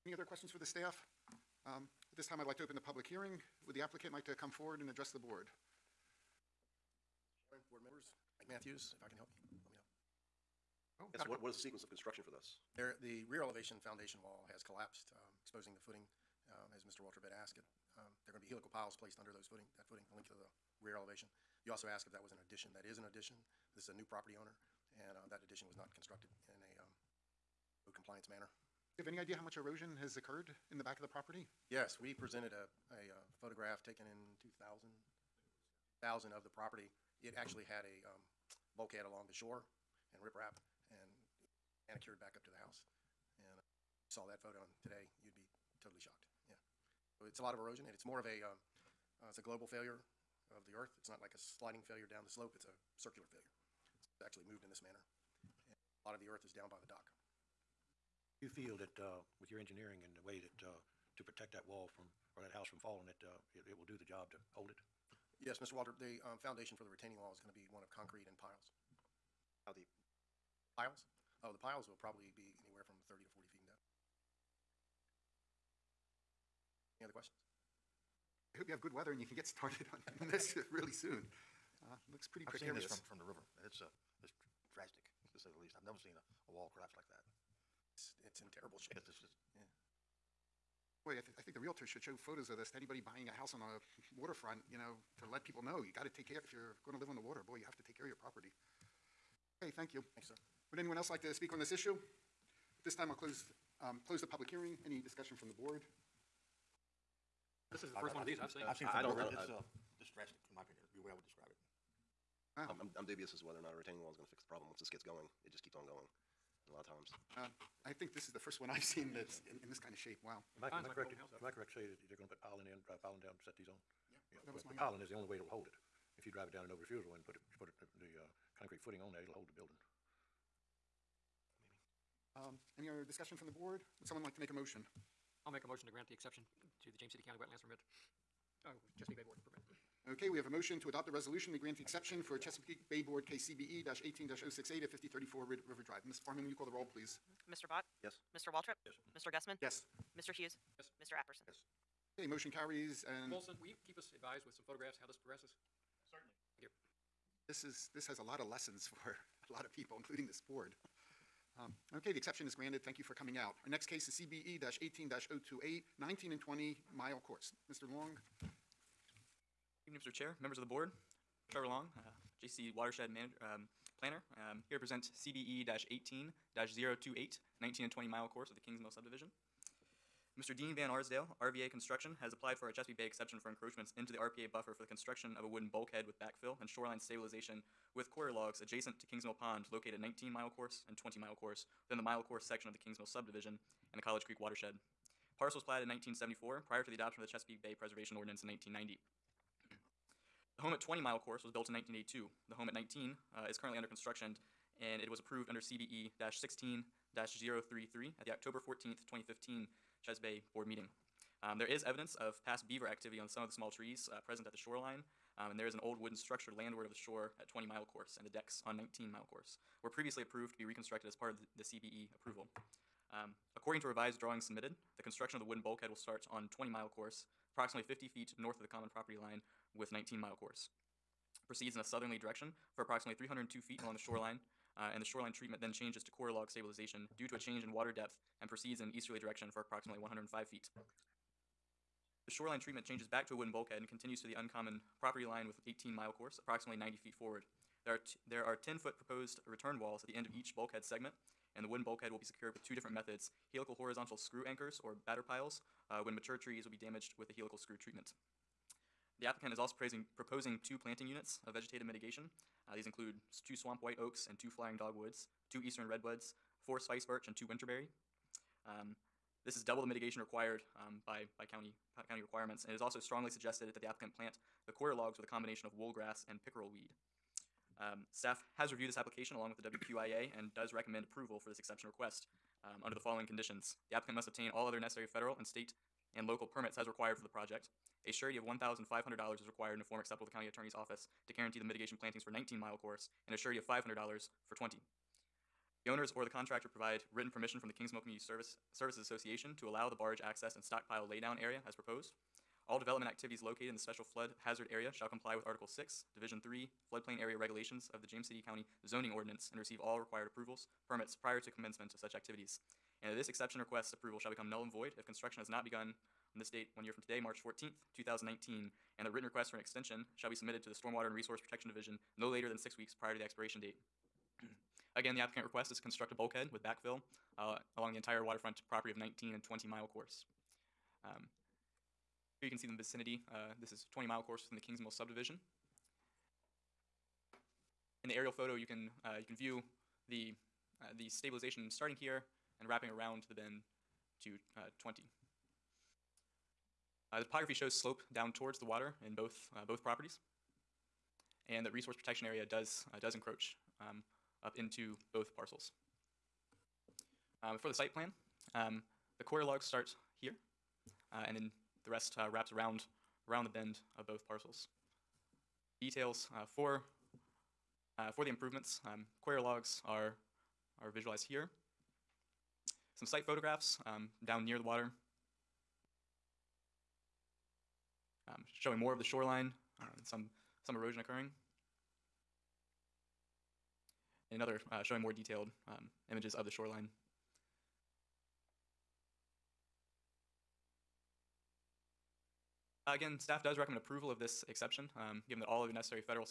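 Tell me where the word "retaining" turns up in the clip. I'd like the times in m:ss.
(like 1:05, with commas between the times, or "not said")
1:06, 1:53.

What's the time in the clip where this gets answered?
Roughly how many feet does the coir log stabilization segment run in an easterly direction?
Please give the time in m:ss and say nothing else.
3:59.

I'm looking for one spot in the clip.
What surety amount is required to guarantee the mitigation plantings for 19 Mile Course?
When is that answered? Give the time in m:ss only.
4:48.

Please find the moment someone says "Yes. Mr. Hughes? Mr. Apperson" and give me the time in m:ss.
2:29.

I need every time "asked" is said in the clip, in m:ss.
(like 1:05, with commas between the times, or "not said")
0:17, 0:21.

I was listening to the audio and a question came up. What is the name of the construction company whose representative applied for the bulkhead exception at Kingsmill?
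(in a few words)
RVA Construction.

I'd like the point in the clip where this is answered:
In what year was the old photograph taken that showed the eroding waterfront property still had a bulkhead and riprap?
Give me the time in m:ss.
0:36.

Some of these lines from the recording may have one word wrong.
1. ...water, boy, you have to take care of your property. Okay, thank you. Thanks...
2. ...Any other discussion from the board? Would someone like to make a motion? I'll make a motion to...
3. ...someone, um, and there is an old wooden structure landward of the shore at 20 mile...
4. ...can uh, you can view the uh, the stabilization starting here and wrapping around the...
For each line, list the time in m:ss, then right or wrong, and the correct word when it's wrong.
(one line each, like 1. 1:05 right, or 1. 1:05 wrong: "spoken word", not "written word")
1. 1:37 right
2. 2:12 right
3. 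3:34 wrong: "shoreline", not "someone"
4. 5:38 right.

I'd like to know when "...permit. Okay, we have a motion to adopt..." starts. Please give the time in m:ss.
2:19.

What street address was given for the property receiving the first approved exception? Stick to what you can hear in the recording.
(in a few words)
5034 River Drive.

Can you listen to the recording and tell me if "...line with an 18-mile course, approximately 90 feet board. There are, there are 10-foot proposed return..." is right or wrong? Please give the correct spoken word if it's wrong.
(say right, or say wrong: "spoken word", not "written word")
wrong: "forward", not "board".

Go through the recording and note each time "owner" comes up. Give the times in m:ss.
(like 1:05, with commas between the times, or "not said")
0:24, 4:55.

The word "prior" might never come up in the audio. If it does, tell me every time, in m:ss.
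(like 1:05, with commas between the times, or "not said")
3:16, 5:11, 5:23.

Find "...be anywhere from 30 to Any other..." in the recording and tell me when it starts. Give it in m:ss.
1:12.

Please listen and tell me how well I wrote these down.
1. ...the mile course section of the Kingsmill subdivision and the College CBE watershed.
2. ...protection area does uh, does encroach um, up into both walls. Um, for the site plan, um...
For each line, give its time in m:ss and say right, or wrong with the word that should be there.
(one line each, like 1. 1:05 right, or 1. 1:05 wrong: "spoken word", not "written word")
1. 3:11 wrong: "Creek", not "CBE"
2. 5:51 wrong: "parcels", not "walls".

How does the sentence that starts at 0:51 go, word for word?
It's not like a sliding failure down the slope.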